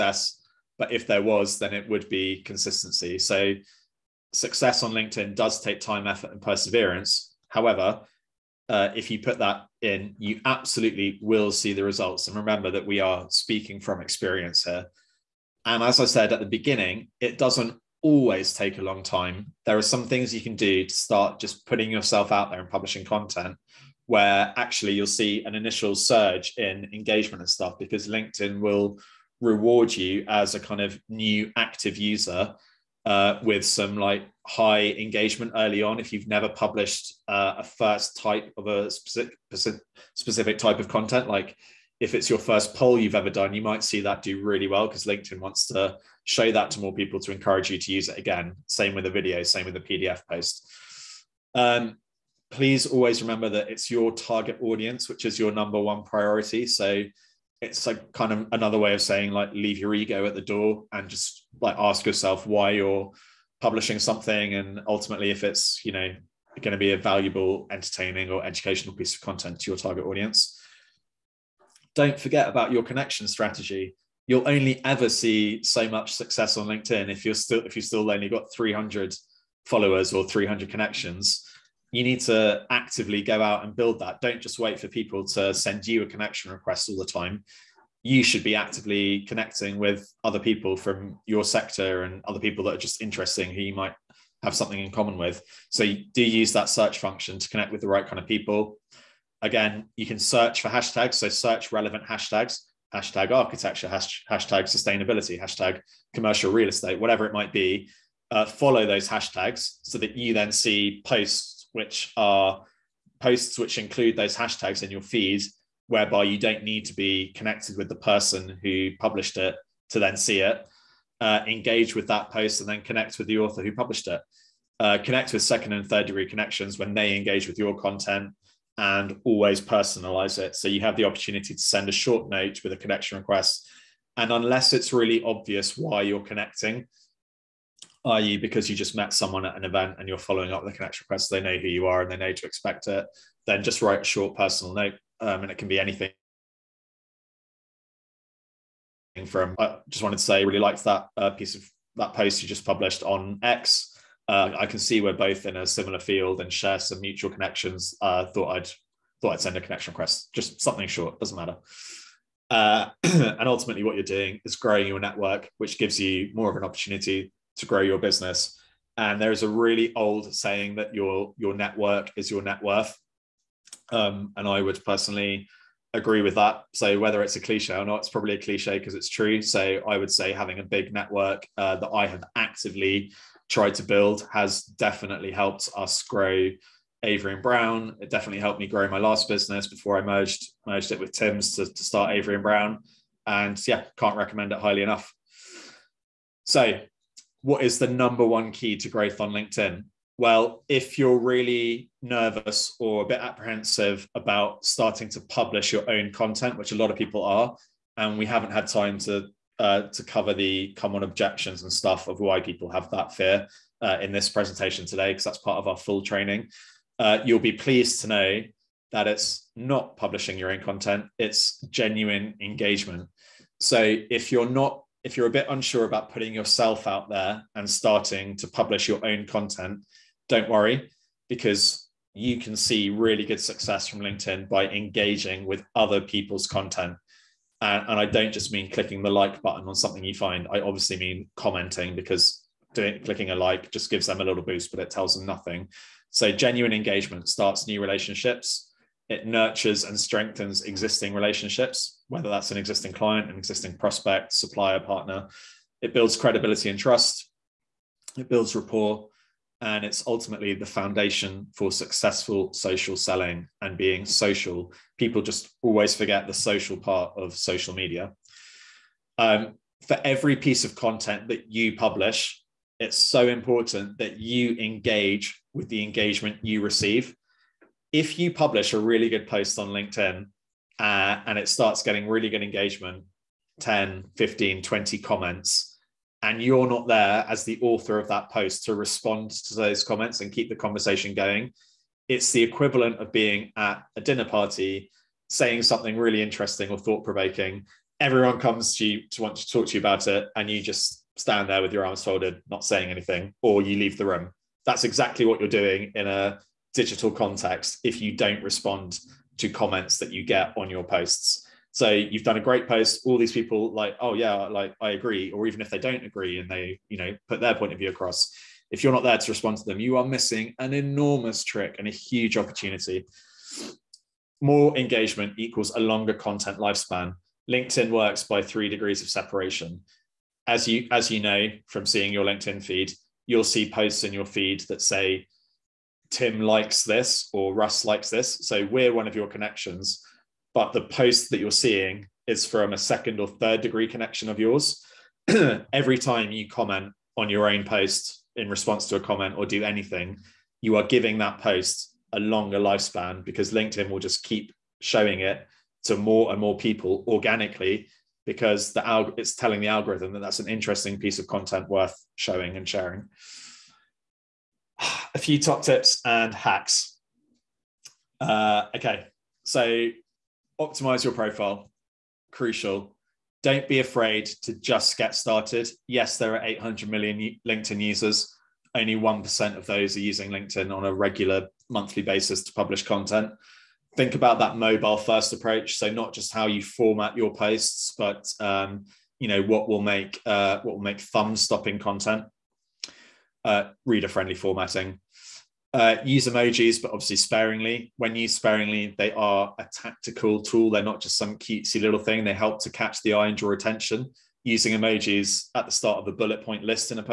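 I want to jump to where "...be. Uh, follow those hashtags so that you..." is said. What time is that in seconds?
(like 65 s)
107 s.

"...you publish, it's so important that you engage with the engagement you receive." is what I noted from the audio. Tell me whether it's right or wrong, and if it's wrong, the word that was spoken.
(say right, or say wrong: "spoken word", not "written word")
right.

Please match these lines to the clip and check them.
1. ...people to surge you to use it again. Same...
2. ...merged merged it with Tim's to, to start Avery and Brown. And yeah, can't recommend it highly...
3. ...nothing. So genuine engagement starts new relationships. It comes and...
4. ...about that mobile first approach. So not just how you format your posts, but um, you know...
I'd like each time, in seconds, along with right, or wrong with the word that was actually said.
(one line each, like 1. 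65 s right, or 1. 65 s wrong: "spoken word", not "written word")
1. 46 s wrong: "encourage", not "surge"
2. 190 s right
3. 245 s wrong: "nurtures", not "comes"
4. 384 s right.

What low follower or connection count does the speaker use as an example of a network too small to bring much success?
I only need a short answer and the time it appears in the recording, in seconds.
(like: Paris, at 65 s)
300, at 78 s.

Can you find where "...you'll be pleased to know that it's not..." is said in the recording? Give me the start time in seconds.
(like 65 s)
217 s.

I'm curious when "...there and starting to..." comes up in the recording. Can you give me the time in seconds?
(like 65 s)
227 s.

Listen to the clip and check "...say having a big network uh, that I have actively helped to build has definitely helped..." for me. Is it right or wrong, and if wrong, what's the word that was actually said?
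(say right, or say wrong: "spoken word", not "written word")
wrong: "tried", not "helped".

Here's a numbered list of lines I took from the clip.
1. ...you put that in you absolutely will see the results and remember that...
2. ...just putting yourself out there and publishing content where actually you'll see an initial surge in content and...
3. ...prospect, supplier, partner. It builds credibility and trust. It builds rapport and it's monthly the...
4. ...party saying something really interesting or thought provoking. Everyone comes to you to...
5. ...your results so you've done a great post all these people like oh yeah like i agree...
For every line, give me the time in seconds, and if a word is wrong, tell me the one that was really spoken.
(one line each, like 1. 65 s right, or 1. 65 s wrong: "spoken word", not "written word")
1. 9 s right
2. 21 s wrong: "engagement", not "content"
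3. 253 s wrong: "ultimately", not "monthly"
4. 294 s right
5. 310 s wrong: "posts", not "results".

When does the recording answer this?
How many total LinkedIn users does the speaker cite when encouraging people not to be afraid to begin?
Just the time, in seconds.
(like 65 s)
376 s.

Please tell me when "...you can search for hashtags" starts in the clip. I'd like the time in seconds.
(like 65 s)
99 s.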